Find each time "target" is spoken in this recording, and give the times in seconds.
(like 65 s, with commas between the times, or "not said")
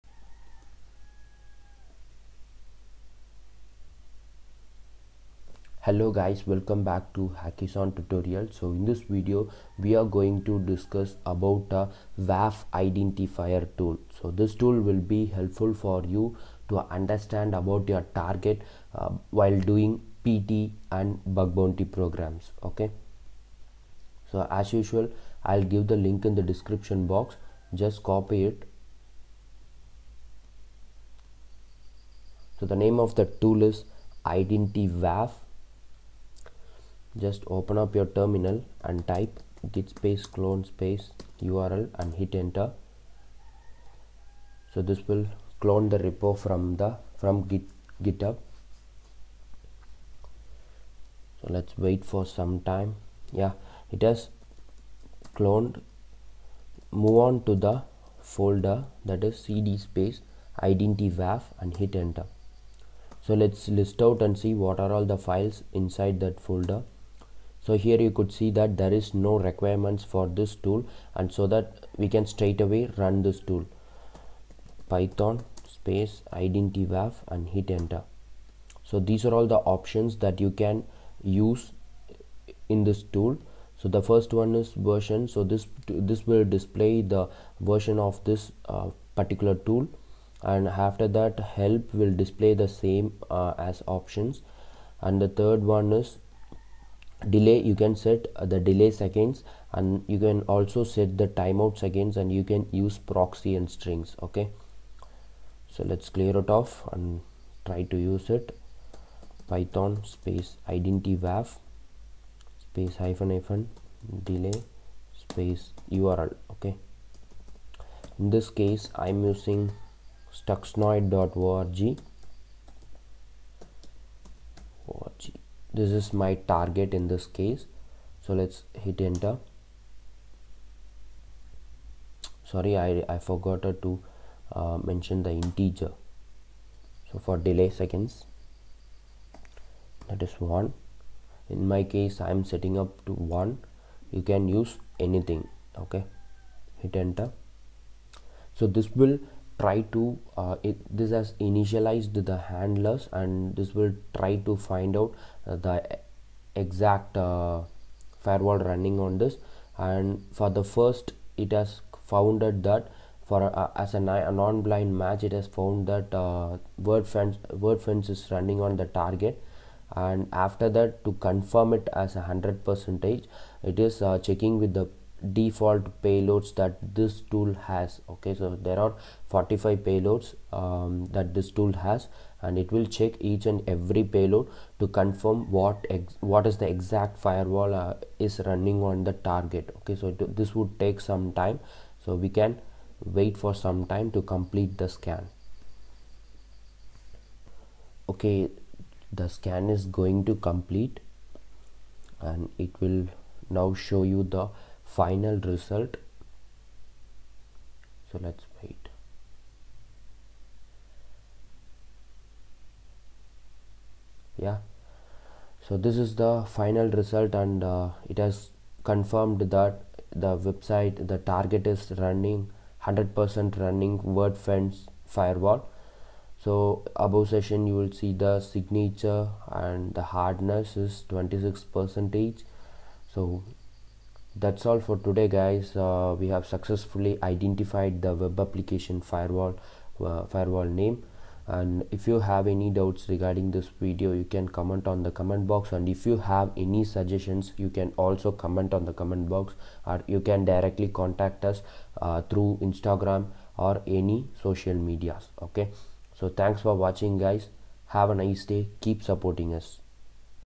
18 s, 126 s, 169 s, 189 s, 221 s.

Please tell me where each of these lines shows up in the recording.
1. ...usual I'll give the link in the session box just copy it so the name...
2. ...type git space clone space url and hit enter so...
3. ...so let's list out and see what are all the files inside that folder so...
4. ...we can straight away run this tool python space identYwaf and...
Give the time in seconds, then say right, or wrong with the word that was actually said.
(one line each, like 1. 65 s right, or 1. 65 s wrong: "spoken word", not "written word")
1. 24 s wrong: "description", not "session"
2. 39 s right
3. 63 s right
4. 71 s right.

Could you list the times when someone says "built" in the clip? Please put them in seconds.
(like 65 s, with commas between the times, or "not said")
not said.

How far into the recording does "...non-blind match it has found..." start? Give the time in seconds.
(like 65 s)
164 s.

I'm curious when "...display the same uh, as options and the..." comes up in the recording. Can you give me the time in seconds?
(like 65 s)
92 s.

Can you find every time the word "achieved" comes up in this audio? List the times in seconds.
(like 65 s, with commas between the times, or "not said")
not said.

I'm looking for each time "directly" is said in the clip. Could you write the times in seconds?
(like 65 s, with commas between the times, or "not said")
250 s.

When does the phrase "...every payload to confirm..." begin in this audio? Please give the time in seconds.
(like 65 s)
183 s.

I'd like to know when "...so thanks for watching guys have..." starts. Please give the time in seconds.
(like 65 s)
256 s.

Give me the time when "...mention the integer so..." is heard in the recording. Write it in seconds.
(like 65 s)
134 s.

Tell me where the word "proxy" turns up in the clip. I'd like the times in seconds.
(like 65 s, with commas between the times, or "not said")
102 s.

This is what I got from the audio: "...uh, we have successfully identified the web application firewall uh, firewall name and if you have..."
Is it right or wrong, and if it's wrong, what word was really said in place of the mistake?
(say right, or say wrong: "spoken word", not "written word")
right.